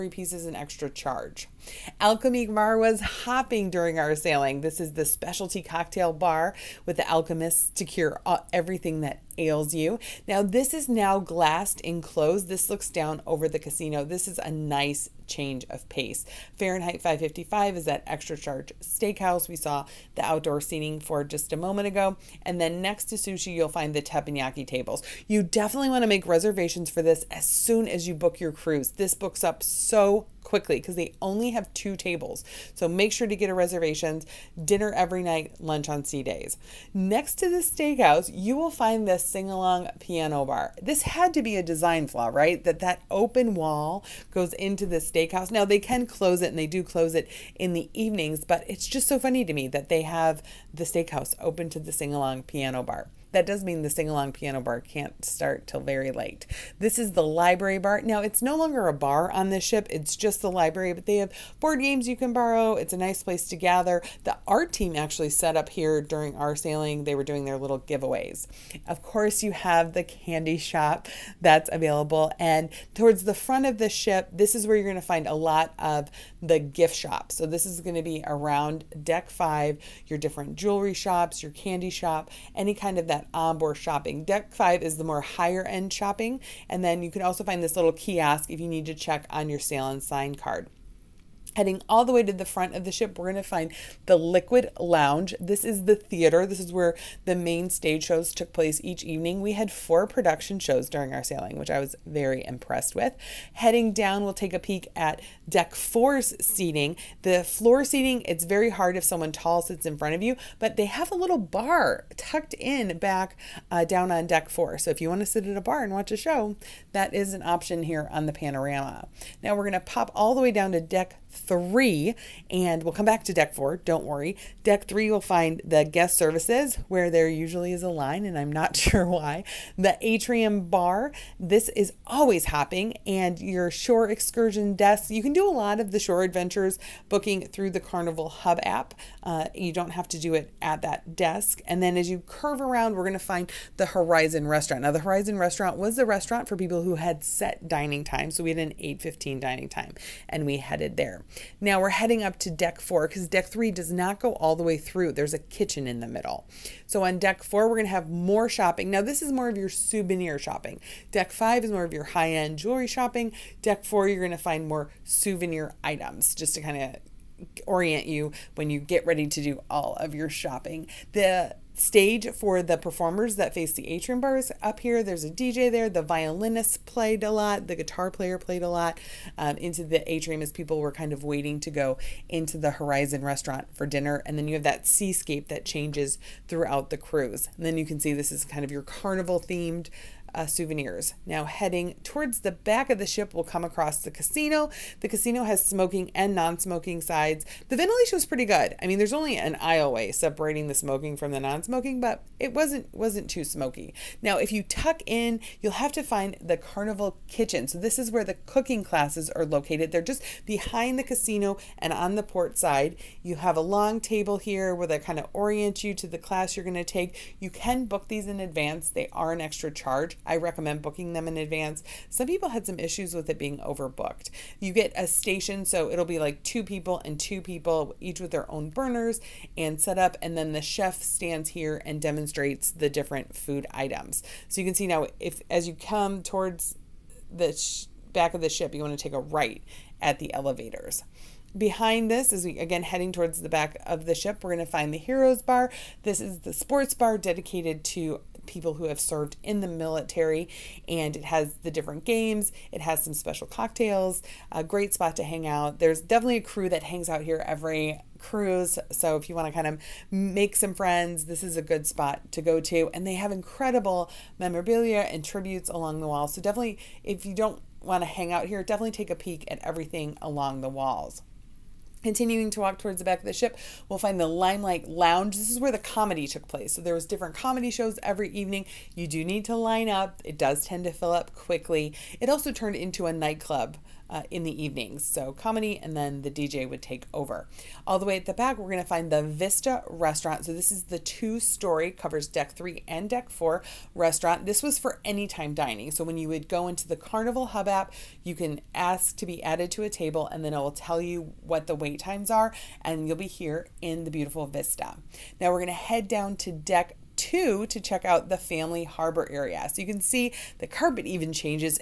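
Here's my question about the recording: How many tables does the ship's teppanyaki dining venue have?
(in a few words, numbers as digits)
2.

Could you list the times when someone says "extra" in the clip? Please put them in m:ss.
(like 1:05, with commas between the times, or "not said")
0:00, 0:18, 3:39.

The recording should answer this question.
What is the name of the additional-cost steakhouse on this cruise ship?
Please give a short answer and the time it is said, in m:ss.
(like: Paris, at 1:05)
Fahrenheit 555, at 0:16.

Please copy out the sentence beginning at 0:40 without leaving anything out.
This had to be a design flaw, right?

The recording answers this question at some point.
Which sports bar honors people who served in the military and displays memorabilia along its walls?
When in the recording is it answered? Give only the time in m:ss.
4:04.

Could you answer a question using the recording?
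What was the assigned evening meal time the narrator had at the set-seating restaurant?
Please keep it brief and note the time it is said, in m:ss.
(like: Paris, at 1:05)
8.15, at 2:28.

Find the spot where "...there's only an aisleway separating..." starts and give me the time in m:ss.
3:18.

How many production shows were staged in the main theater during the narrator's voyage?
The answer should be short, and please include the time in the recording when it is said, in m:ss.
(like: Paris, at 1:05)
4, at 1:39.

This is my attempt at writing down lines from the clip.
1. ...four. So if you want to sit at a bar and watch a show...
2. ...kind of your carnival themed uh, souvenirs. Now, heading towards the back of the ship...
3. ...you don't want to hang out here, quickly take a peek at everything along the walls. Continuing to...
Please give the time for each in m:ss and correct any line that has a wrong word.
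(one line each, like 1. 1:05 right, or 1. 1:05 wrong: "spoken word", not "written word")
1. 1:54 right
2. 3:08 right
3. 4:27 wrong: "definitely", not "quickly".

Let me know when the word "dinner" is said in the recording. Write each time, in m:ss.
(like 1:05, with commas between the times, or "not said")
0:34, 3:03.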